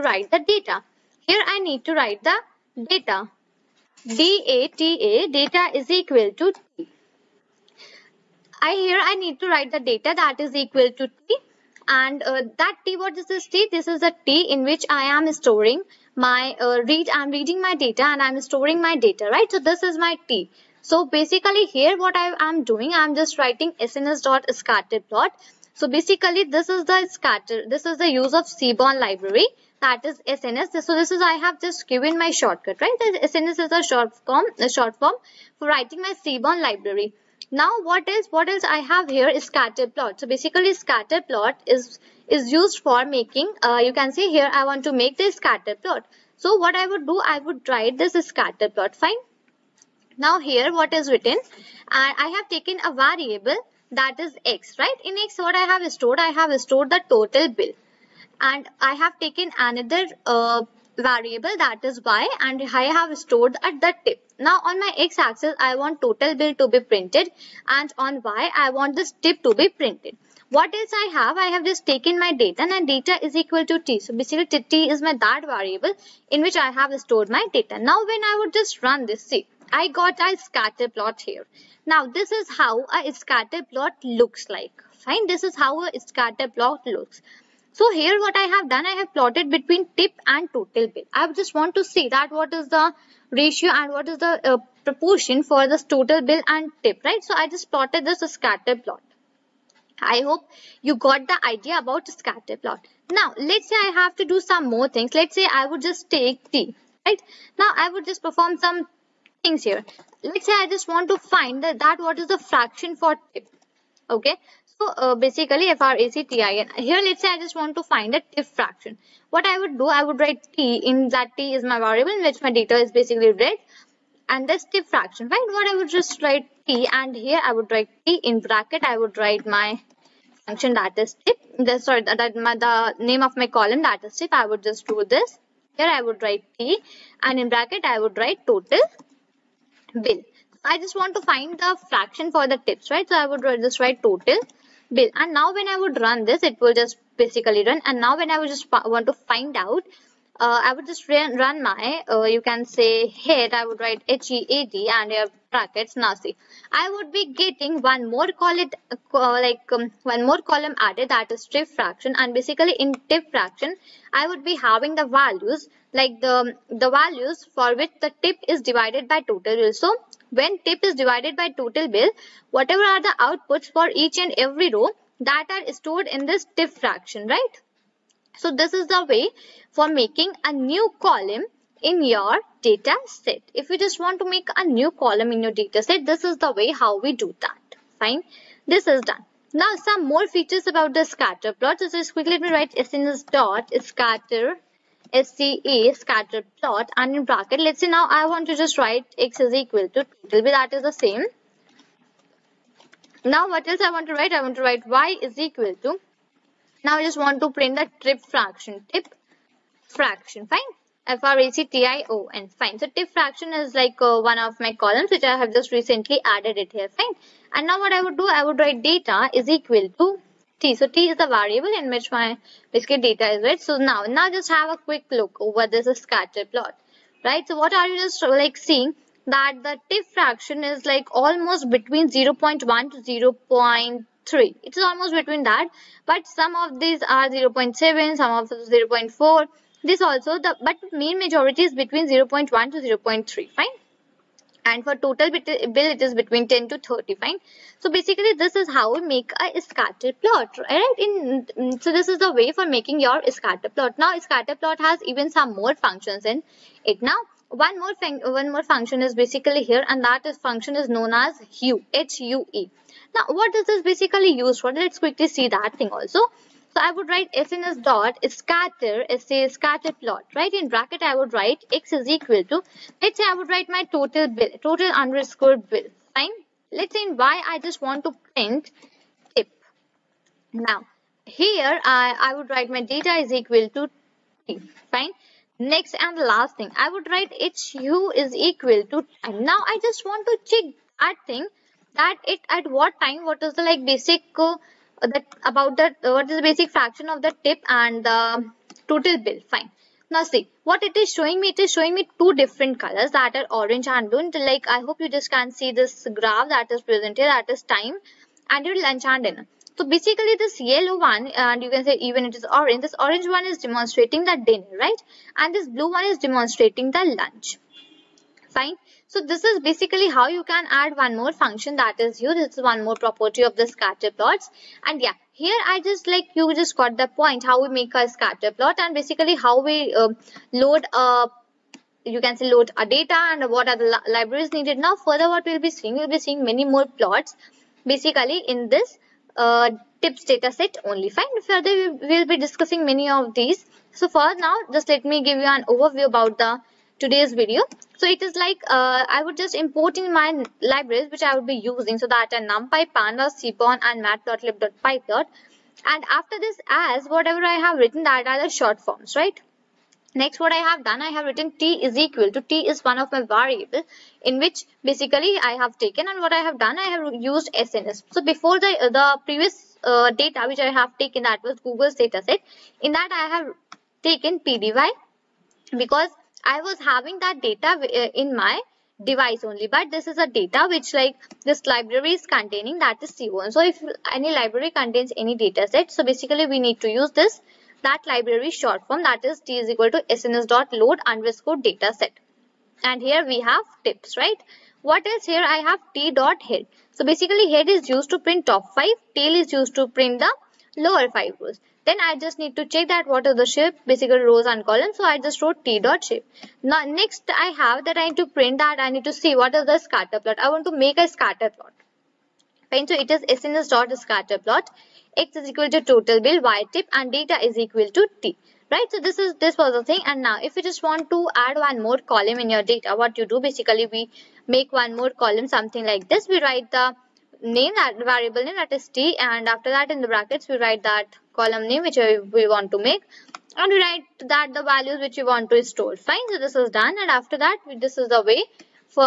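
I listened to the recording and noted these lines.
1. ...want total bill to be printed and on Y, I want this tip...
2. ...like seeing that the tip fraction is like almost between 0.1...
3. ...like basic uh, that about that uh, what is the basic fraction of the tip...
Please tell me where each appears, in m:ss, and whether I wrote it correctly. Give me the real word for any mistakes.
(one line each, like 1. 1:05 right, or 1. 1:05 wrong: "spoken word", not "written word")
1. 1:05 right
2. 3:48 right
3. 4:53 right.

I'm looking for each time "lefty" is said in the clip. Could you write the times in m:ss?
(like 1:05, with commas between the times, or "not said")
not said.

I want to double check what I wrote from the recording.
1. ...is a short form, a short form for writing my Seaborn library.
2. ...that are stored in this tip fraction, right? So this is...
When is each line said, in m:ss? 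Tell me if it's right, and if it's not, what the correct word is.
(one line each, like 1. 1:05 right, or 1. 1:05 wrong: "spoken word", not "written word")
1. 0:33 right
2. 2:55 right.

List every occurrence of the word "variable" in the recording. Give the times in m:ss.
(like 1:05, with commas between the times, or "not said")
0:52, 1:00, 1:15, 2:01, 3:41, 6:03, 7:08.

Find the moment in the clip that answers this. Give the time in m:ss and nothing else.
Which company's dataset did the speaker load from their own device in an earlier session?
6:11.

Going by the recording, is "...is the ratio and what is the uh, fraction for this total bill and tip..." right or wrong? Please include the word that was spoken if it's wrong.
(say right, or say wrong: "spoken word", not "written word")
wrong: "proportion", not "fraction".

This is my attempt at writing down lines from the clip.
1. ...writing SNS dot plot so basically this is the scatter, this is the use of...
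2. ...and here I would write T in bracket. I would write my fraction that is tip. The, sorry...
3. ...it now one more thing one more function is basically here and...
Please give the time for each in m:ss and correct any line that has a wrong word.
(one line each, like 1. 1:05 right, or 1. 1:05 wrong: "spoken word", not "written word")
1. 0:23 right
2. 2:06 wrong: "function", not "fraction"
3. 4:16 right.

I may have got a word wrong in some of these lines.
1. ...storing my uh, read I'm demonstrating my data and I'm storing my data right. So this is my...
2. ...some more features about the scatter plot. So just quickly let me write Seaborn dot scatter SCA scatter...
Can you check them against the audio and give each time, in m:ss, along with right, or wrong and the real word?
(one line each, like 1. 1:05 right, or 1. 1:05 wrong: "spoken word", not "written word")
1. 0:15 wrong: "reading", not "demonstrating"
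2. 3:09 wrong: "SNS", not "Seaborn".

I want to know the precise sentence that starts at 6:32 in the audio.
And here we have tips, right?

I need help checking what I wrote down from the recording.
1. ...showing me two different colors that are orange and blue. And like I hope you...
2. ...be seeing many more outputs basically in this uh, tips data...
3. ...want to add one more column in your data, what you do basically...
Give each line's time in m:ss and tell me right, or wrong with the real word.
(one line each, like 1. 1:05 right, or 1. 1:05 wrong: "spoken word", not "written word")
1. 5:01 right
2. 5:36 wrong: "plots", not "outputs"
3. 7:00 right.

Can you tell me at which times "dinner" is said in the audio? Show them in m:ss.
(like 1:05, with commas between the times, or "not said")
5:09, 5:14.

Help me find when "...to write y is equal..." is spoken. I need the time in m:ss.
3:24.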